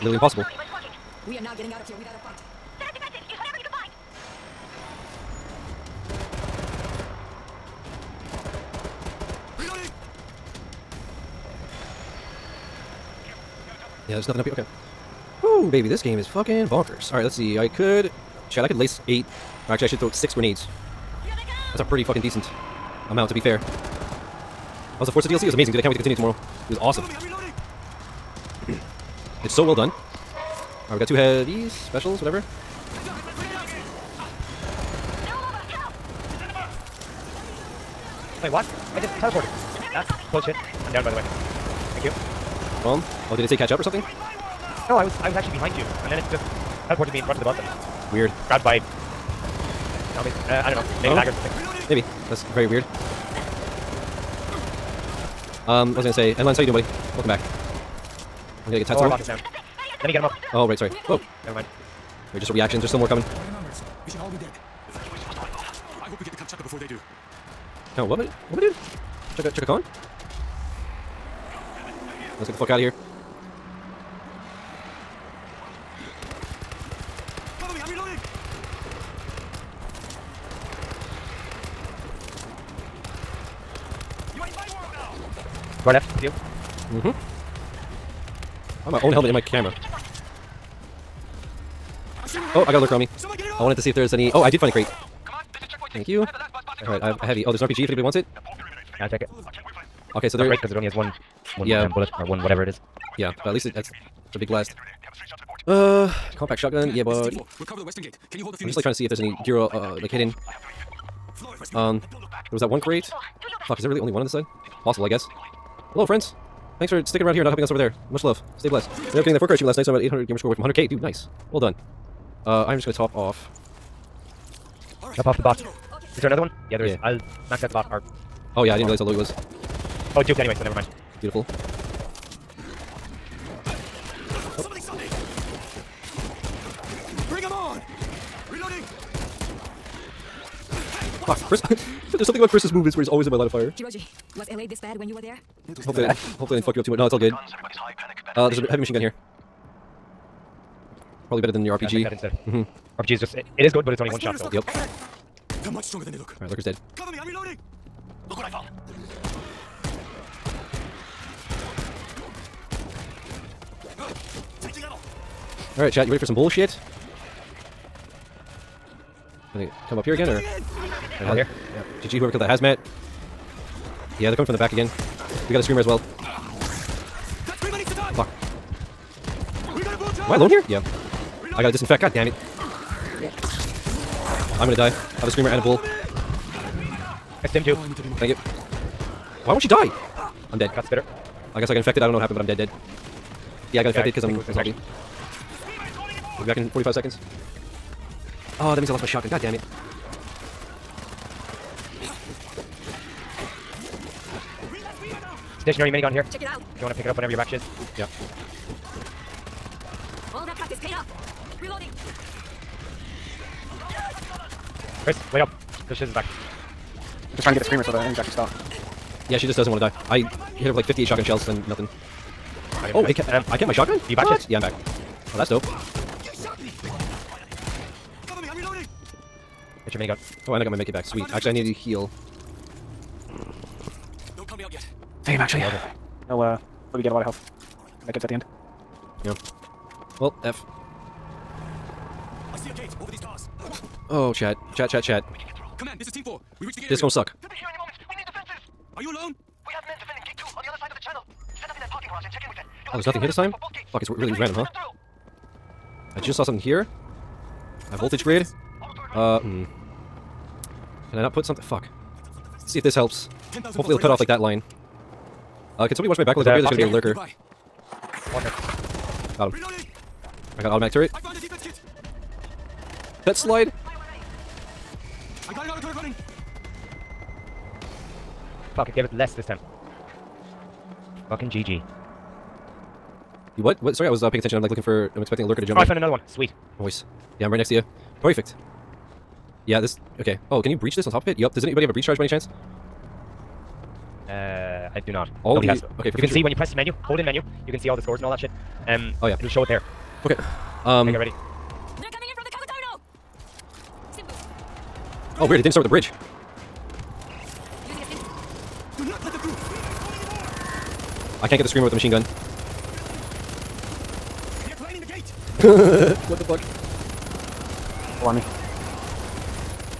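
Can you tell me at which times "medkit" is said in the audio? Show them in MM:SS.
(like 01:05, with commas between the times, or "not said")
03:50, 03:58.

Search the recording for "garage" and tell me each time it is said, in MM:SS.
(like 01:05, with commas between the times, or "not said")
04:12.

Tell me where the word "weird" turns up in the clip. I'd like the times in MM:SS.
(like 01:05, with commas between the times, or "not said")
00:48, 00:52, 05:05.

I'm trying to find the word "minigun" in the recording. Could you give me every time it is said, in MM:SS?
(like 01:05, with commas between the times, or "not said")
03:25, 03:49.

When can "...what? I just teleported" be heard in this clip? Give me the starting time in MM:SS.
00:38.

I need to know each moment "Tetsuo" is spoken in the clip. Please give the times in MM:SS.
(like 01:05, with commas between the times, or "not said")
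00:58.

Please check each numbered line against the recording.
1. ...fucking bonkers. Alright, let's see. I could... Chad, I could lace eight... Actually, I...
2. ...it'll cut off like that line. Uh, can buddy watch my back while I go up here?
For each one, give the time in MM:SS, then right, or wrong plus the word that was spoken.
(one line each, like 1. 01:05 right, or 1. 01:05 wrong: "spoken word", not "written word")
1. 00:16 right
2. 04:23 wrong: "somebody", not "buddy".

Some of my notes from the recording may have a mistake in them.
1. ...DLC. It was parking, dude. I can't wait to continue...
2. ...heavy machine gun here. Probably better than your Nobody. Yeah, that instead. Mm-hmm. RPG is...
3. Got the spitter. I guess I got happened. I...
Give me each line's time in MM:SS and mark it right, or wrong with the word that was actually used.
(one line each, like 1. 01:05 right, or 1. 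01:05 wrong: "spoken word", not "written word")
1. 00:25 wrong: "amazing", not "parking"
2. 02:28 wrong: "RPG", not "Nobody"
3. 03:10 wrong: "infected", not "happened".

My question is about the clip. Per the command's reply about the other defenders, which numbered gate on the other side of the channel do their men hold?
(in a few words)
Gate 2.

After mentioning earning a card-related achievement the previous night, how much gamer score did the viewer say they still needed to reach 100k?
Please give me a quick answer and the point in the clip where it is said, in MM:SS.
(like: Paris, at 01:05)
800, at 02:00.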